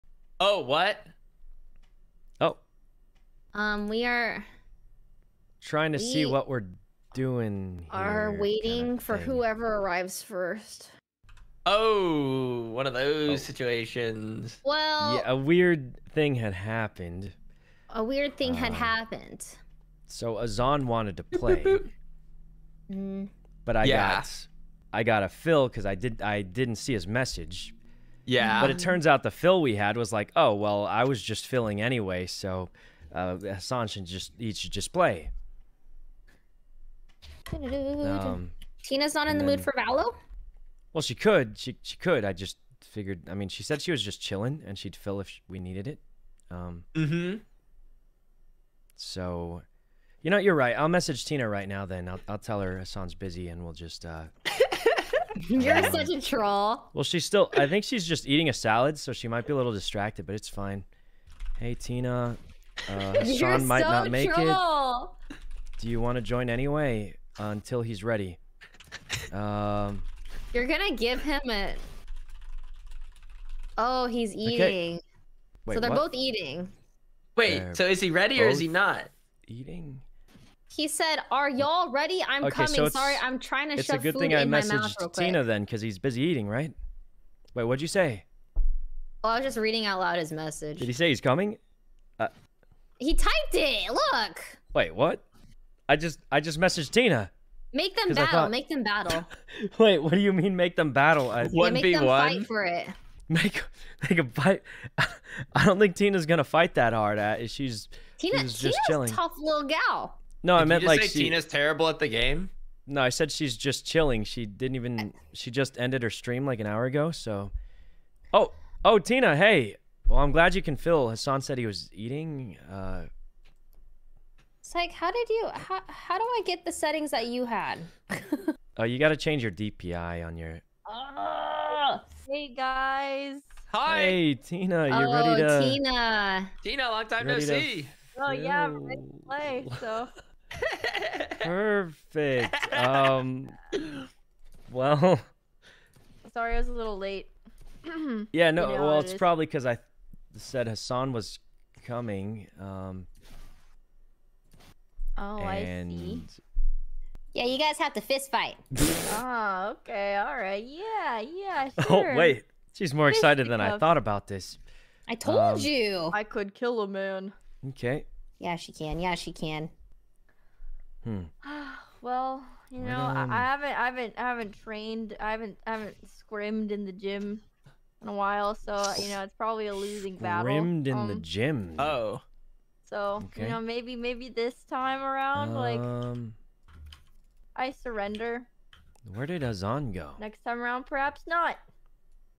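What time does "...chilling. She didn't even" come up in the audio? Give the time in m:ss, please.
1:53.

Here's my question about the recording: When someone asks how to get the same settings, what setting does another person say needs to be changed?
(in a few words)
DPI.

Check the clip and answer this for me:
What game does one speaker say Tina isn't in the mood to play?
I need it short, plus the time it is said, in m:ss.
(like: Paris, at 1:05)
Valo, at 0:39.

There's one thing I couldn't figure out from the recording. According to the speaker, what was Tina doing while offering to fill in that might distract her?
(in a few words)
Eating a salad.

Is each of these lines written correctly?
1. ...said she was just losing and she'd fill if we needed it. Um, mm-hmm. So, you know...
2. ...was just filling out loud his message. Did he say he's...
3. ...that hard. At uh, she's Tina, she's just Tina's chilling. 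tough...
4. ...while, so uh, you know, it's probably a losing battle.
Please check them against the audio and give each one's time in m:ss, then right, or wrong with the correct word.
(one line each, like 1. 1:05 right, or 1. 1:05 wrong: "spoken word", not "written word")
1. 0:43 wrong: "chilling", not "losing"
2. 1:29 wrong: "reading", not "filling"
3. 1:46 right
4. 2:58 right.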